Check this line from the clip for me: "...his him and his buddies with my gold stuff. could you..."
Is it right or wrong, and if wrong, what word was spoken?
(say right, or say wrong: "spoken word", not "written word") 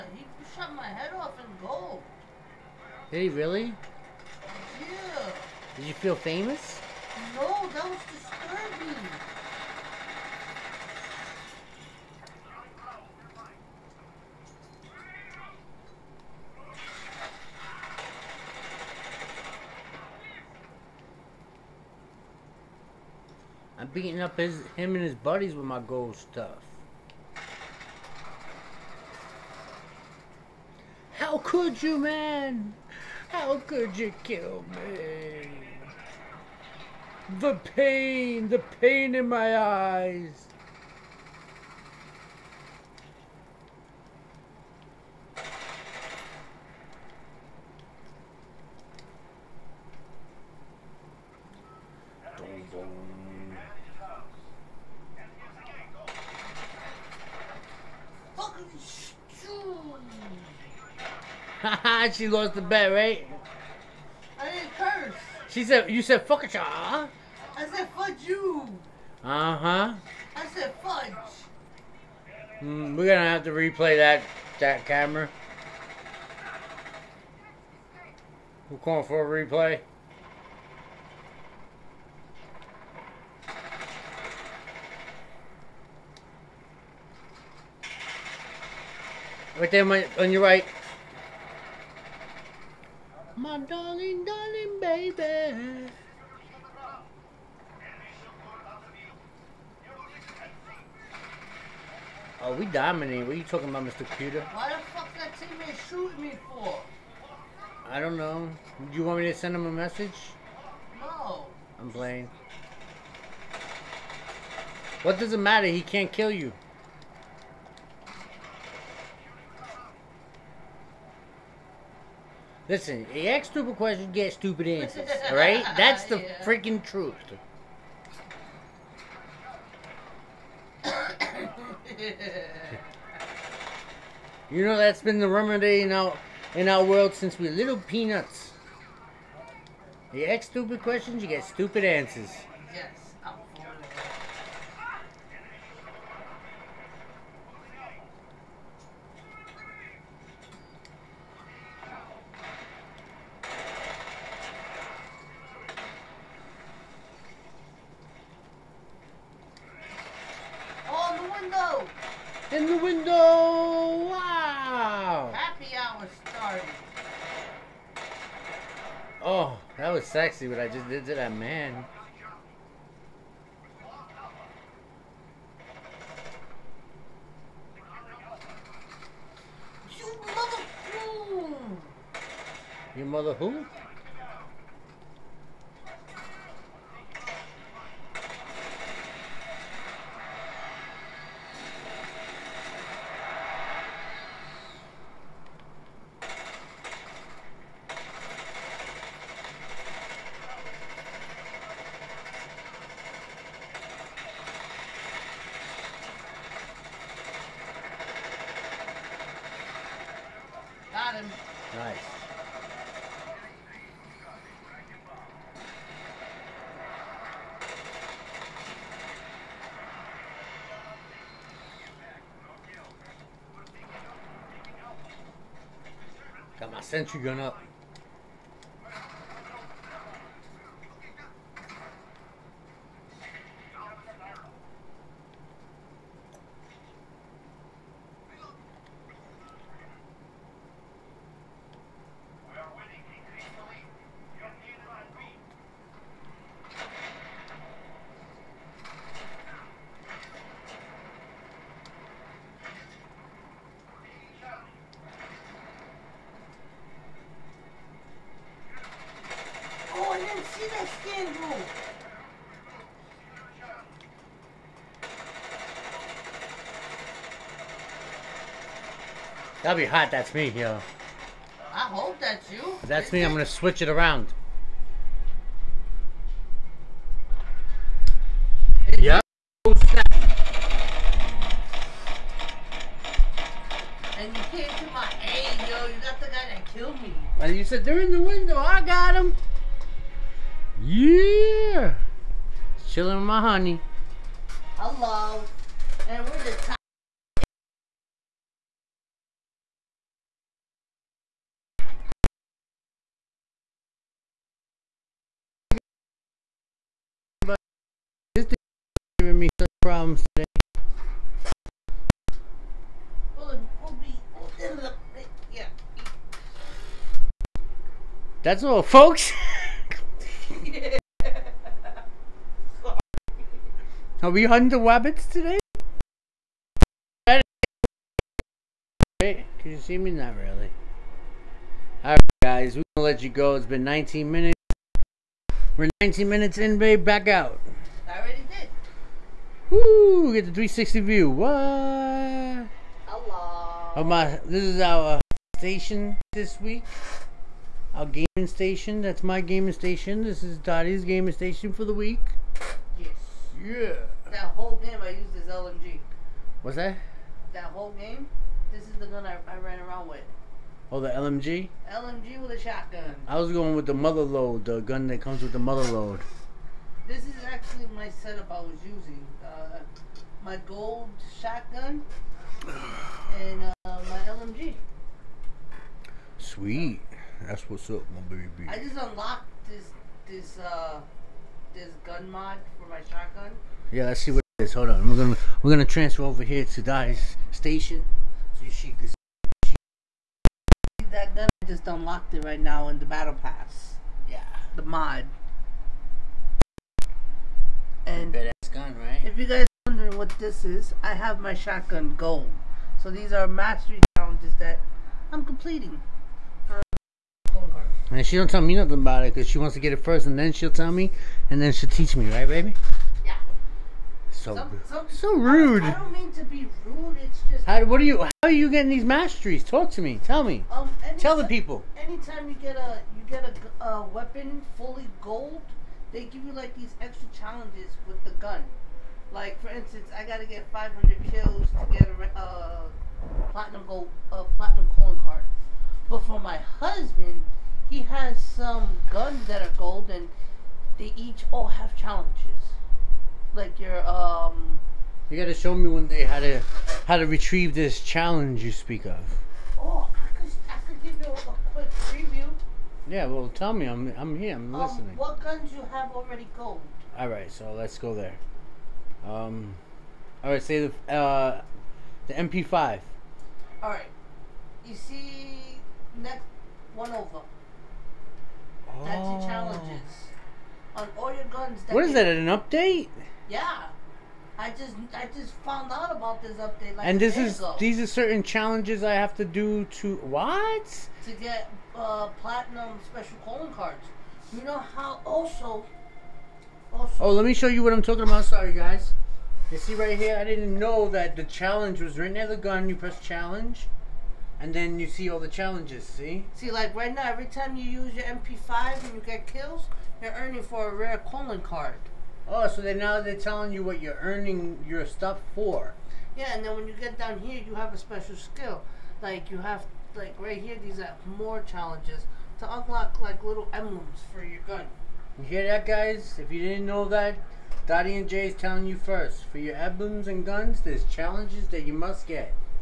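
right.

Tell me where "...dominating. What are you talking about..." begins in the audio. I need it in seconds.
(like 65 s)
102 s.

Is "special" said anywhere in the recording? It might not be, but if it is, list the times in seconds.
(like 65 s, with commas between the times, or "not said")
483 s, 507 s.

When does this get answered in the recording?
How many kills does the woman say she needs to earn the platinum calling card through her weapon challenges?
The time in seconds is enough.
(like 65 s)
430 s.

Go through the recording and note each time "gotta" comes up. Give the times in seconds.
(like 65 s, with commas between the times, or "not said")
430 s, 445 s.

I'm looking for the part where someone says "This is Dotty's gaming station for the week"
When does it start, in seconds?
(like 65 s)
350 s.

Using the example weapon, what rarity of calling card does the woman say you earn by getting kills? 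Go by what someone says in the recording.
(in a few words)
rare.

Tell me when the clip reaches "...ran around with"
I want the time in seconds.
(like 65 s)
359 s.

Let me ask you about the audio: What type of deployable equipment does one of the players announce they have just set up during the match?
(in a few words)
sentry gun.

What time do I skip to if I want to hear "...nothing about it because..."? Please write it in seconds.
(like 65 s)
408 s.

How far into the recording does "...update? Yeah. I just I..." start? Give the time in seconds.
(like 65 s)
472 s.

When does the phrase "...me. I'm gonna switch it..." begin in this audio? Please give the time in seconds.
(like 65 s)
273 s.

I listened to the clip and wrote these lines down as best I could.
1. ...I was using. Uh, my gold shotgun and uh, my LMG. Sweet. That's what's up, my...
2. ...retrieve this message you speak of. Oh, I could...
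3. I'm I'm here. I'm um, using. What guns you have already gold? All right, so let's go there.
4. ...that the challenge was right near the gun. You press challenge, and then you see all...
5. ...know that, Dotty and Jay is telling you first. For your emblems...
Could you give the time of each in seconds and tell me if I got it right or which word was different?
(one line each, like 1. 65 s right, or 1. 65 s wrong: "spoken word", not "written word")
1. 368 s right
2. 447 s wrong: "challenge", not "message"
3. 453 s wrong: "listening", not "using"
4. 491 s right
5. 516 s right.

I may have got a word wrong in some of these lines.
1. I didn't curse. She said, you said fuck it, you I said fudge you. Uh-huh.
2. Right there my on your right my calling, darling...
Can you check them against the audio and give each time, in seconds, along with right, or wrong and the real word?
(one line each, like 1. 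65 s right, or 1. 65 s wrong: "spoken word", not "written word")
1. 64 s right
2. 89 s wrong: "darling", not "calling".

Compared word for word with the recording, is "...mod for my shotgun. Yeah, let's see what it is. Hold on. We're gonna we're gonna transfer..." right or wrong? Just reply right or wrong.
right.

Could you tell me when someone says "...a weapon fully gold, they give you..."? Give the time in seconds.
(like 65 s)
423 s.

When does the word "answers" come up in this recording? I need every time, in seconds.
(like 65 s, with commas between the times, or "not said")
124 s, 141 s.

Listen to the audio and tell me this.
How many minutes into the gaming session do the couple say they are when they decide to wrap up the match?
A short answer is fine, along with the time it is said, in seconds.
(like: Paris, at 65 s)
19, at 336 s.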